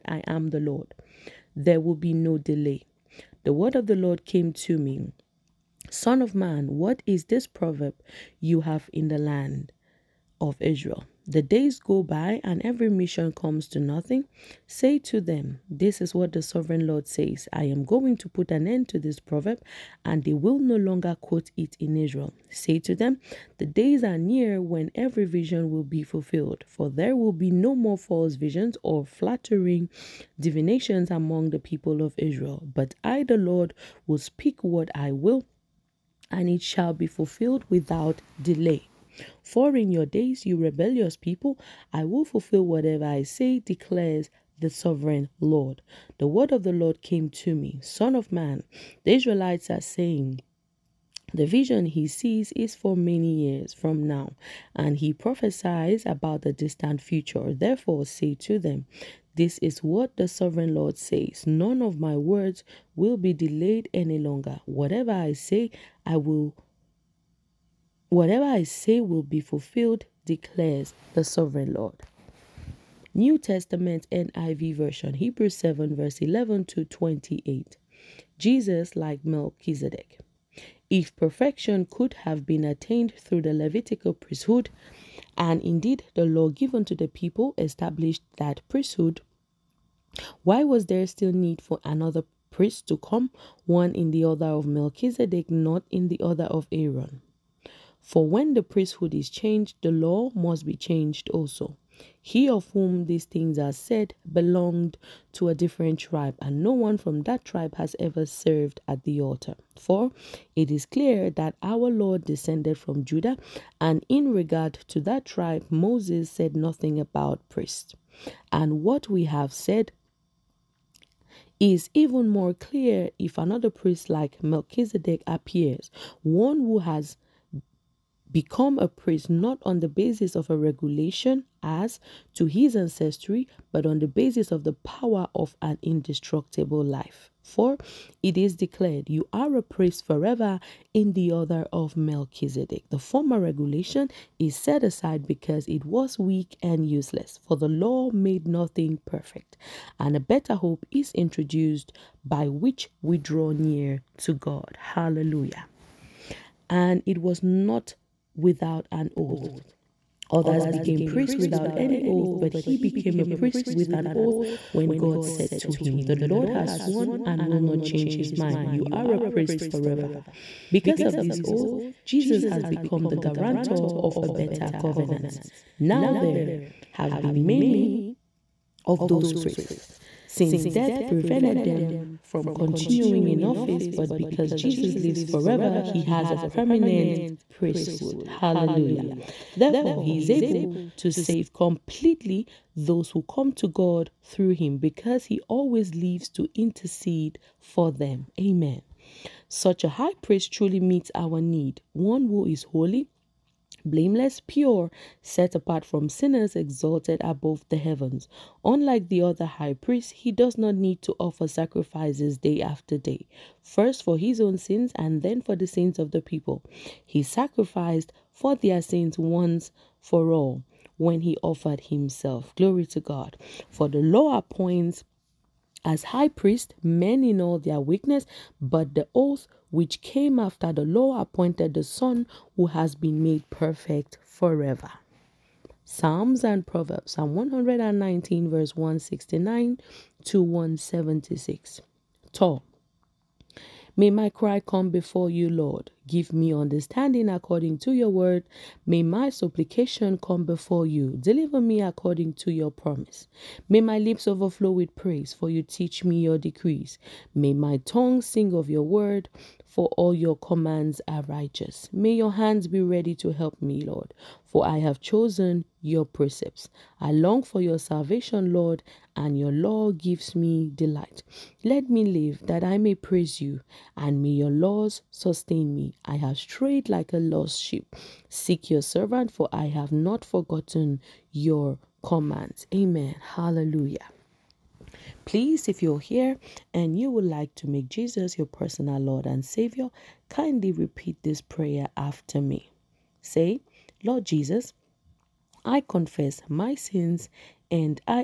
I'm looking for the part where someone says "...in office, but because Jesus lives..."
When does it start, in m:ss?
3:03.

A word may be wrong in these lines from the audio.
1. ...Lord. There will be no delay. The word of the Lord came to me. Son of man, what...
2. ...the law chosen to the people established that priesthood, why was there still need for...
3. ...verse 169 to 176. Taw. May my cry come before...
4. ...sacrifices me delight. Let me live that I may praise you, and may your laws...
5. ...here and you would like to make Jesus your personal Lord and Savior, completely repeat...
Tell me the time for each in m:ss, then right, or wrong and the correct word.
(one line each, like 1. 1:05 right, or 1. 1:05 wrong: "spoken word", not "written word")
1. 0:00 right
2. 1:26 wrong: "given", not "chosen"
3. 3:58 right
4. 4:29 wrong: "gives", not "sacrifices"
5. 4:45 wrong: "kindly", not "completely".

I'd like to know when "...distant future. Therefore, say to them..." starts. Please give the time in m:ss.
0:56.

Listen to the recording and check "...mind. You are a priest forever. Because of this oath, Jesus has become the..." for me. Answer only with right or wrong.
right.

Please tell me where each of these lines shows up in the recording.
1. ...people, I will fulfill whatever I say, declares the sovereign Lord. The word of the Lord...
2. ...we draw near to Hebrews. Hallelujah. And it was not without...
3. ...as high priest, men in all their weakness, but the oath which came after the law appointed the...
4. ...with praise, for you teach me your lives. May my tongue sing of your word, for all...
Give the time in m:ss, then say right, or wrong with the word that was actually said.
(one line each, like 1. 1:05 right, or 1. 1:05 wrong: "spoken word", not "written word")
1. 0:41 right
2. 2:33 wrong: "God", not "Hebrews"
3. 3:45 right
4. 4:14 wrong: "decrees", not "lives".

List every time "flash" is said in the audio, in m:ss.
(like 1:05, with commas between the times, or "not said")
not said.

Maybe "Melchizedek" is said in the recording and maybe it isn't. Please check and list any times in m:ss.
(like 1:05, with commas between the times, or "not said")
1:19, 1:34, 2:04, 2:21.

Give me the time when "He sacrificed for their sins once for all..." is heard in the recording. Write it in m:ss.
3:37.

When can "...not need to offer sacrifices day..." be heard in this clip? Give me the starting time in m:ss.
3:30.